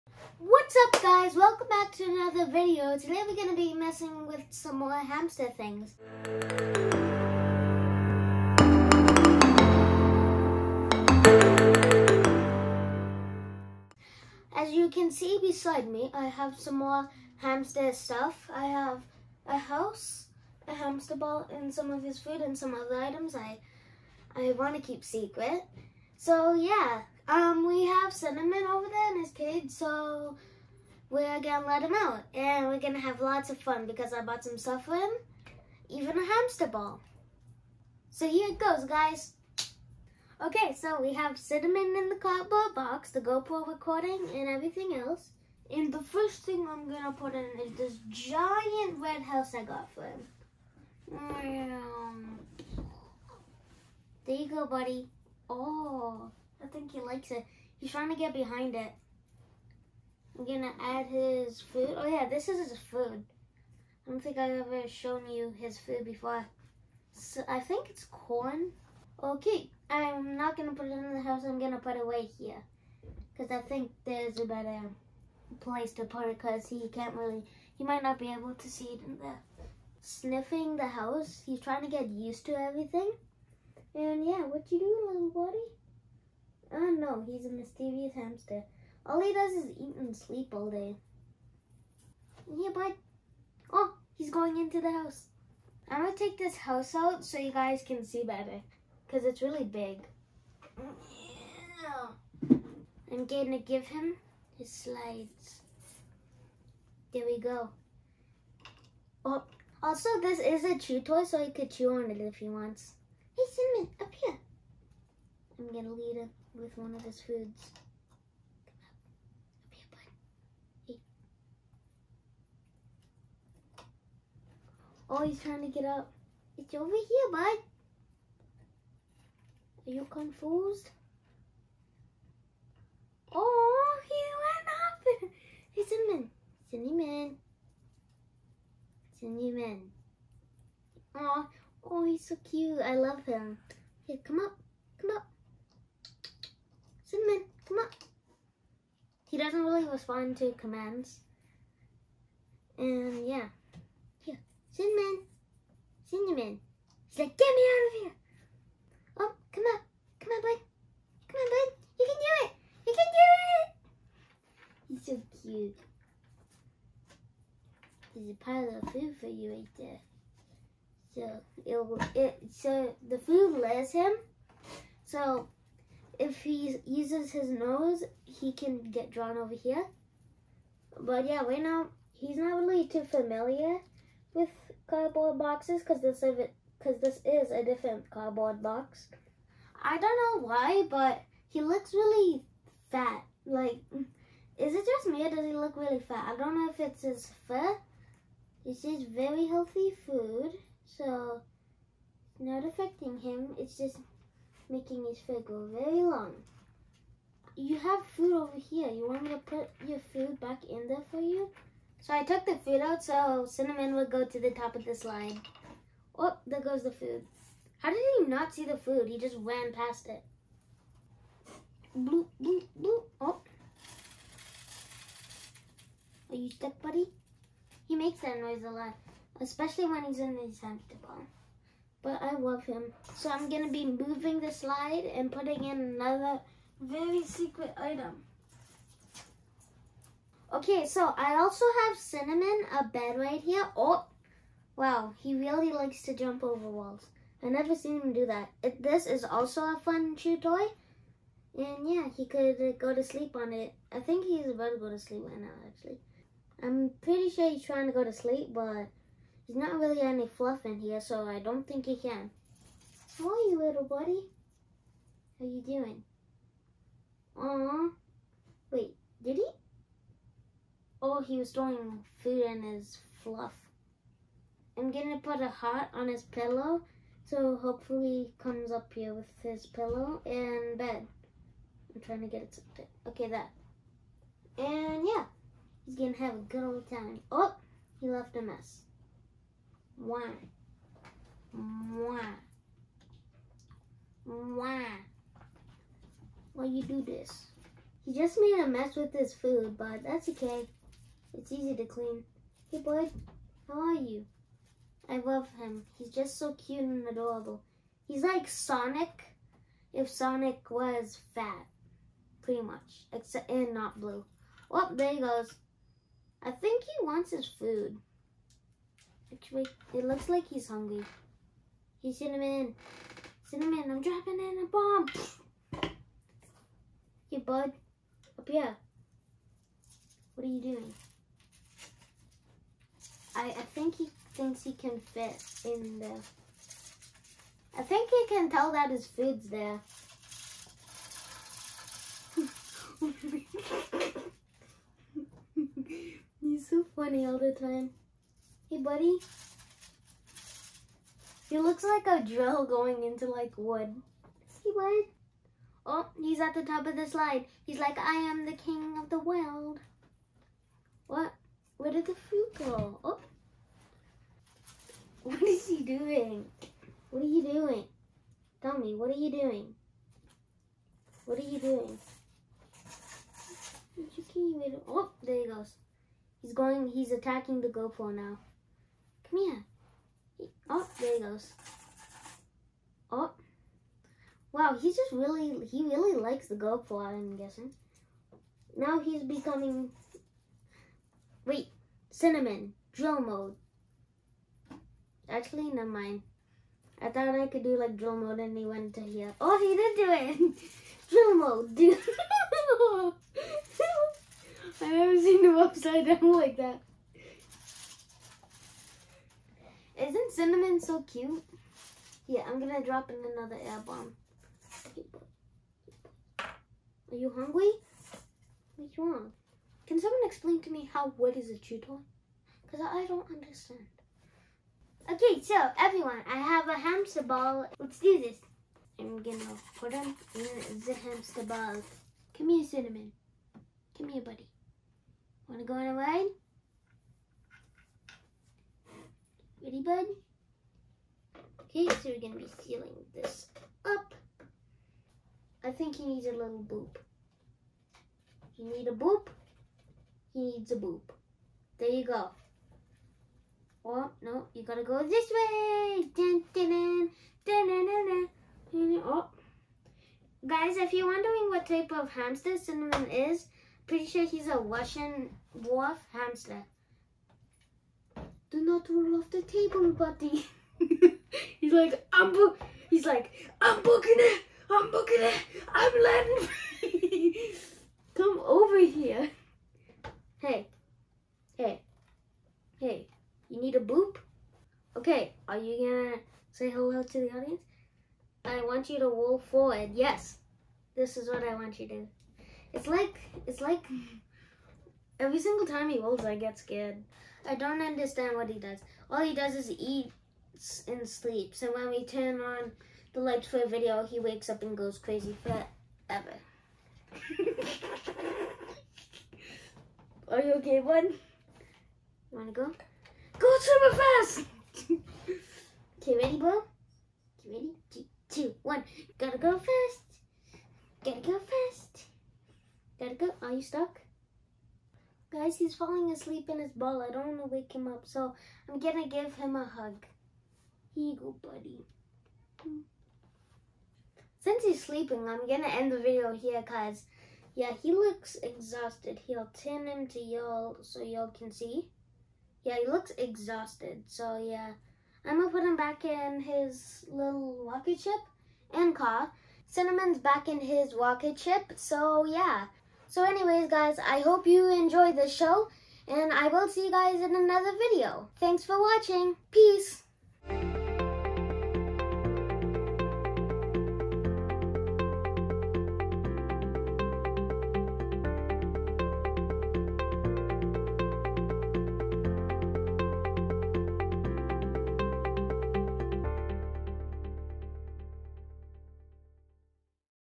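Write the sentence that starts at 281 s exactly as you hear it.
I'm trying to get it something.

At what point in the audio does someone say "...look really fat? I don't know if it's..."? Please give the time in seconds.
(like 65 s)
195 s.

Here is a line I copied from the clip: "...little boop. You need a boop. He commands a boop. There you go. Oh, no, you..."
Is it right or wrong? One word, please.
wrong.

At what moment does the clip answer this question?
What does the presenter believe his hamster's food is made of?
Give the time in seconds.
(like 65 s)
67 s.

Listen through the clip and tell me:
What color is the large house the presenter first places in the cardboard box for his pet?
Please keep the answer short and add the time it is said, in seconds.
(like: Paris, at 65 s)
Red, at 48 s.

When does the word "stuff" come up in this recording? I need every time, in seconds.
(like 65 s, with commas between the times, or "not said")
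17 s, 34 s.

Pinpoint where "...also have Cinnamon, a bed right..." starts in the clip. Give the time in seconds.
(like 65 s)
241 s.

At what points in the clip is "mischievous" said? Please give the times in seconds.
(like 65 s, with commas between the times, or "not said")
87 s.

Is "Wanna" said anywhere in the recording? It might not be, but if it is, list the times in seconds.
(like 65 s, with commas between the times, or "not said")
435 s, 512 s.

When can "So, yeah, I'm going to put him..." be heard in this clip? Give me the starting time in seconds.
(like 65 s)
544 s.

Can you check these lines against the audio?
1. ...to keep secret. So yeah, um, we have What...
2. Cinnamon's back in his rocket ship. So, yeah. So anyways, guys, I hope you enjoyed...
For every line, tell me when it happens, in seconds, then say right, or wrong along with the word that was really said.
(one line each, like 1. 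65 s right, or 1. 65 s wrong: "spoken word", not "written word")
1. 24 s wrong: "Cinnamon", not "What"
2. 549 s right.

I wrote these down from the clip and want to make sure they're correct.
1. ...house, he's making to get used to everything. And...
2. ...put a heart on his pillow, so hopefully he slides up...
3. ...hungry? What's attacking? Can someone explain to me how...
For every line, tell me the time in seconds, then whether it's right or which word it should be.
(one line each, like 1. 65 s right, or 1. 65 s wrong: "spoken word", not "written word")
1. 80 s wrong: "trying", not "making"
2. 275 s wrong: "comes", not "slides"
3. 417 s wrong: "wrong", not "attacking".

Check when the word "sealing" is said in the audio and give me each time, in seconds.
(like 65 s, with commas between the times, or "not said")
442 s.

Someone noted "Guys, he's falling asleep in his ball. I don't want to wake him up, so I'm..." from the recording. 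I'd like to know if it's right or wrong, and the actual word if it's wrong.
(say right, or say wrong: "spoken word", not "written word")
right.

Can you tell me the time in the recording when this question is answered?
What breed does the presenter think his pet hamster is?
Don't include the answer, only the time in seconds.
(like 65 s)
464 s.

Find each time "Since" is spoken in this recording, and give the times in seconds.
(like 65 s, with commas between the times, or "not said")
534 s.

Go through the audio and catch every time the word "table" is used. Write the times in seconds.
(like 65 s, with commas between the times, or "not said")
469 s.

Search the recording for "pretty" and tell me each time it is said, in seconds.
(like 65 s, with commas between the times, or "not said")
257 s, 312 s, 463 s.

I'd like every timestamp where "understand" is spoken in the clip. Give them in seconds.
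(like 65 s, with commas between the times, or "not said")
423 s, 497 s.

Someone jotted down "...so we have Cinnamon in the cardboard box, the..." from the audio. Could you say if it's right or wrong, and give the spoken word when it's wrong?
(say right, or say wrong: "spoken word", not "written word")
right.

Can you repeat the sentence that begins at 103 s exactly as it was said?
I'm gonna give him his slides.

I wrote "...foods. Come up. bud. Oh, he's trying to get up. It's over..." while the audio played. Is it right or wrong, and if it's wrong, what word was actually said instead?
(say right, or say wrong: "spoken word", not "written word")
right.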